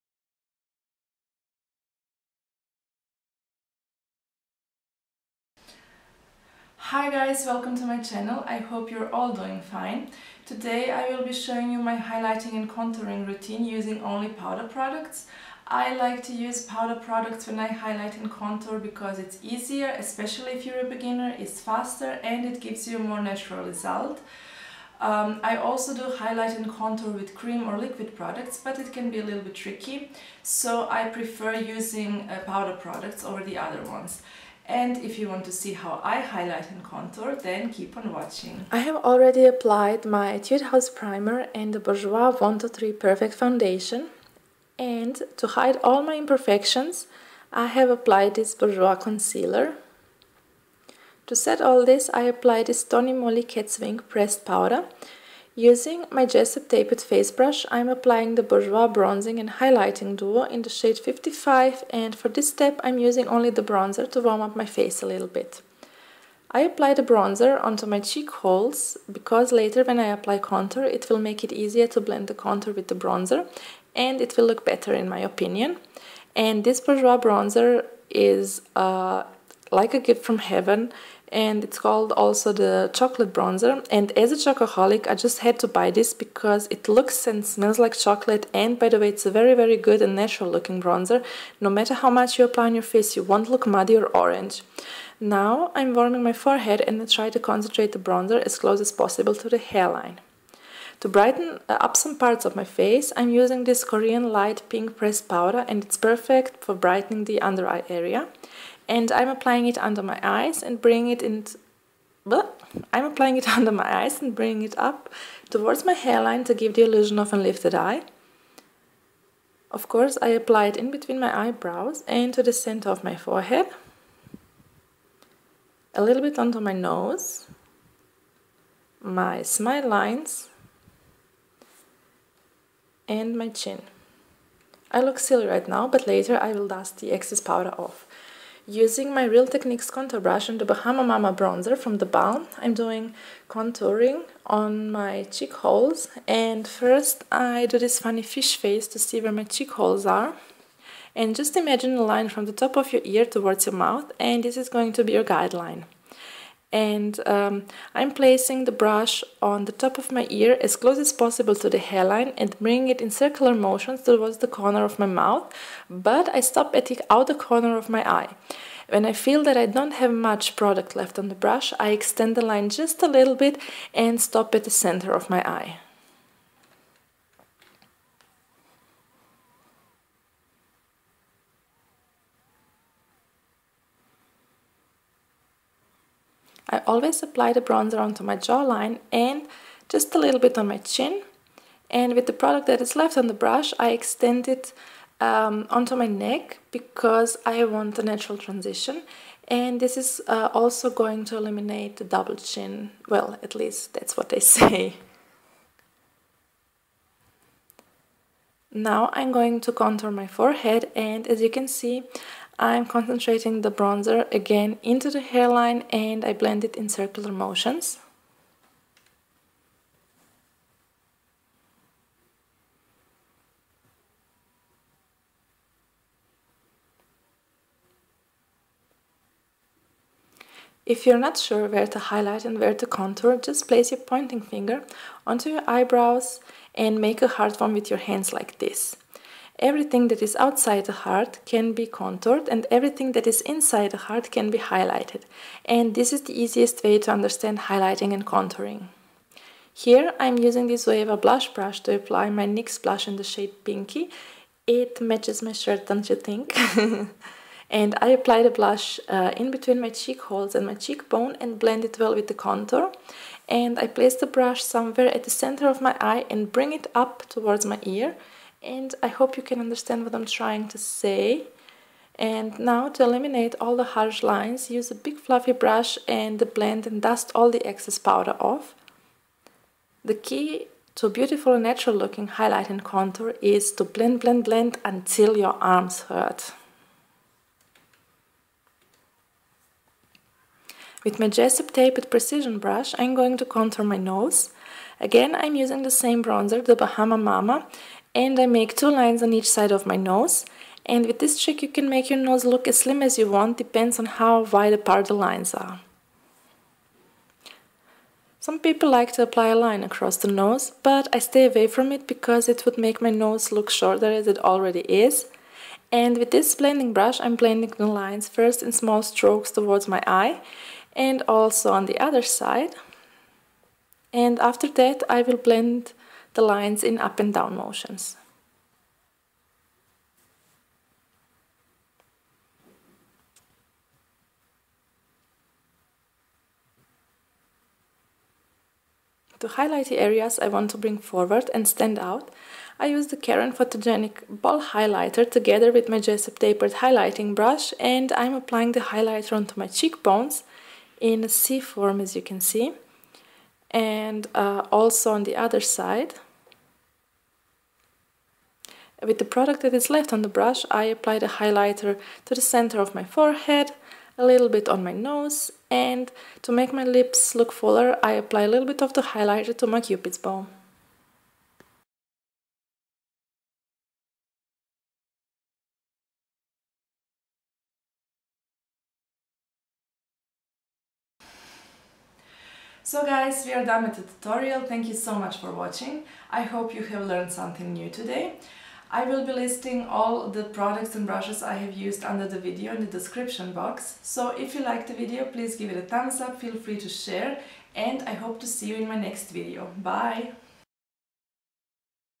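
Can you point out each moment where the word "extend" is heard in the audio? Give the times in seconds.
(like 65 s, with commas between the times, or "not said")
171 s, 193 s.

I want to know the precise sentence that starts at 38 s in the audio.
I have already applied my Etude House Primer and the Bourjois 123 Perfect Foundation.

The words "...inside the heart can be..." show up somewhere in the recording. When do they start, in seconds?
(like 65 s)
243 s.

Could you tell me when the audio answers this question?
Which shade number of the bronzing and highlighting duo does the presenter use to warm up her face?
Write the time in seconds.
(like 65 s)
60 s.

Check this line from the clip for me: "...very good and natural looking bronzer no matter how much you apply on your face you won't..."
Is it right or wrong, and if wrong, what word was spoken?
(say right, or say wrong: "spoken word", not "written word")
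right.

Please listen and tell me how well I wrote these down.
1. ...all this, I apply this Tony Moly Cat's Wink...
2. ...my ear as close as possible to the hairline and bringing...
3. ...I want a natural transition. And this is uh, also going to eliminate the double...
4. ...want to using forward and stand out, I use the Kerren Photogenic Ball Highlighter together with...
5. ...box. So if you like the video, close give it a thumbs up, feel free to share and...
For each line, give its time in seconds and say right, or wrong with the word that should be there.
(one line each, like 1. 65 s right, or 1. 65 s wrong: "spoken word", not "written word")
1. 51 s right
2. 160 s right
3. 197 s right
4. 340 s wrong: "bring", not "using"
5. 393 s wrong: "please", not "close".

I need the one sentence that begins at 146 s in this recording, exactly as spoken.
And first I do this funny fish face to see where my cheek holes are.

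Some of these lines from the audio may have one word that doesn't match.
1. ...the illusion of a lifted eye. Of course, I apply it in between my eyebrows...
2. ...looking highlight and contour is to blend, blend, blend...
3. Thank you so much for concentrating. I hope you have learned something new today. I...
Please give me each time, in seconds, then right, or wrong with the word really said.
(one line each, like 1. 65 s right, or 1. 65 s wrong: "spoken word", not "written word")
1. 116 s right
2. 281 s right
3. 384 s wrong: "watching", not "concentrating".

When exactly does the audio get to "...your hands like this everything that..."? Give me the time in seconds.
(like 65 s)
237 s.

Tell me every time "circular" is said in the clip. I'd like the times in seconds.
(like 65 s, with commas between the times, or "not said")
163 s, 216 s.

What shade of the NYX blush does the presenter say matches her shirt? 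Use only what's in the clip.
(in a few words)
Pinky.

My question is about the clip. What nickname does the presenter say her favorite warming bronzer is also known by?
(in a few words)
chocolate bronzer.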